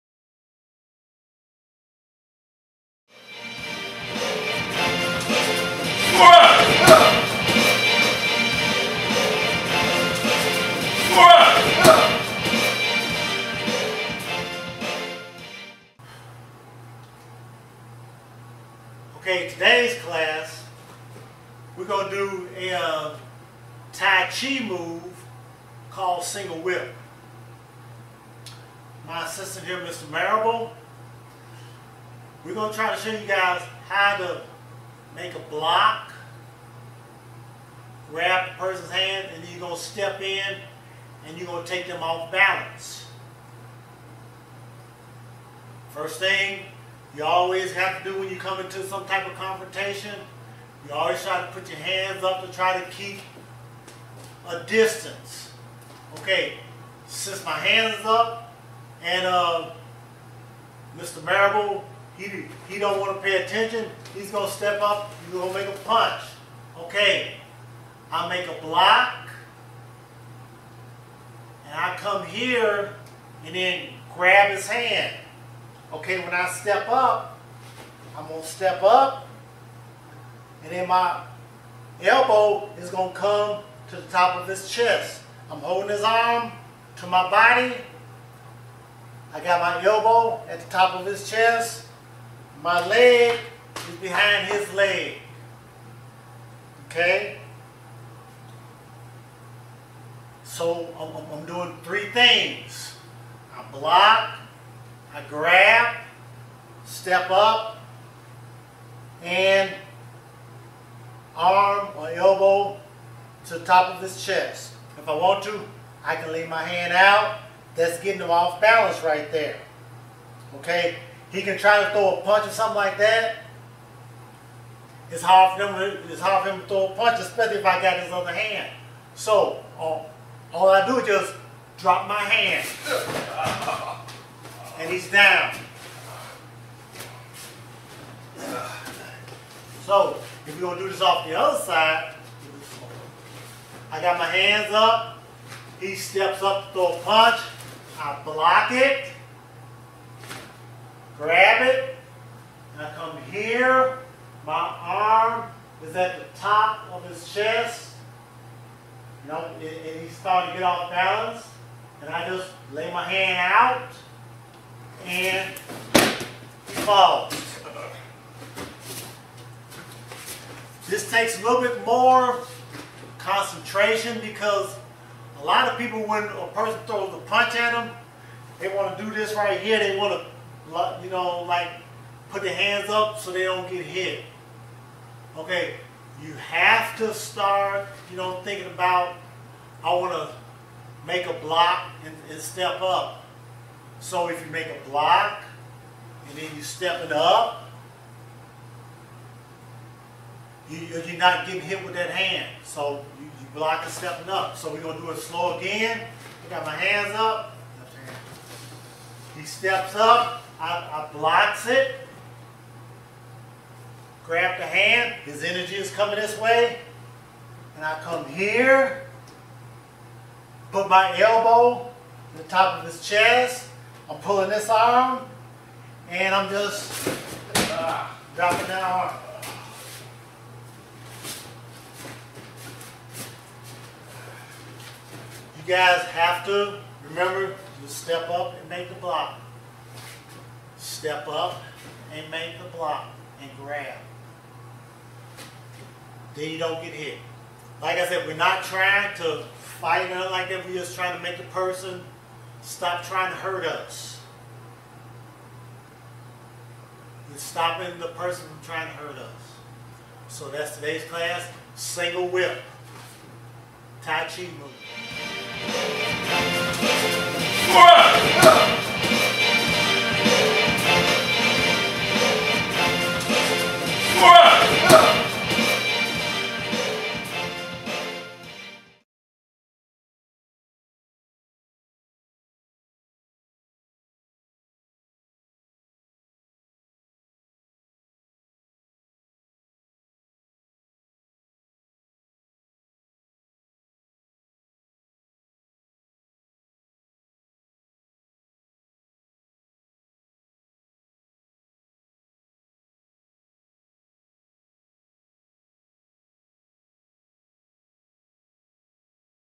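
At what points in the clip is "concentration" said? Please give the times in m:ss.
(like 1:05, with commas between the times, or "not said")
2:53.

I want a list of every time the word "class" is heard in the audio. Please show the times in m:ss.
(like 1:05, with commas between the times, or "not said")
0:20, 4:21.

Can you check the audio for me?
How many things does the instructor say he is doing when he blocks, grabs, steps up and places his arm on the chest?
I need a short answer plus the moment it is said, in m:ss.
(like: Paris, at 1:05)
3, at 1:41.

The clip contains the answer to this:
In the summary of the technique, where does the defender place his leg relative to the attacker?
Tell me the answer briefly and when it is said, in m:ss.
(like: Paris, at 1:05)
Behind his leg, at 1:34.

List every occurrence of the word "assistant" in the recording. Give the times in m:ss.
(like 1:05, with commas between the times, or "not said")
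0:29.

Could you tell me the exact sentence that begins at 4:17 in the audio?
We're stopping the person from trying to hurt us.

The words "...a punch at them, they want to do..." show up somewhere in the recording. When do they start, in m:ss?
2:57.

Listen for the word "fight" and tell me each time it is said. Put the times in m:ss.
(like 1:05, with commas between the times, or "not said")
4:09.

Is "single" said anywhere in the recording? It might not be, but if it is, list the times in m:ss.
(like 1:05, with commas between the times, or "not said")
0:26, 4:21.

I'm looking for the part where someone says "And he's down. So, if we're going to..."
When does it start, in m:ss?
2:14.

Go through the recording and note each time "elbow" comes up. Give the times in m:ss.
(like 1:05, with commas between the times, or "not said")
1:22, 1:29, 1:52, 3:41.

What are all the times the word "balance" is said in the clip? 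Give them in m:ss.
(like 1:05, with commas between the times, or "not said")
0:42, 1:58, 2:40.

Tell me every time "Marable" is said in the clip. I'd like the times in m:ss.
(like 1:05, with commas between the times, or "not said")
0:30, 1:01.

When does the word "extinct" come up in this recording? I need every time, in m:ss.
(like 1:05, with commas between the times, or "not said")
not said.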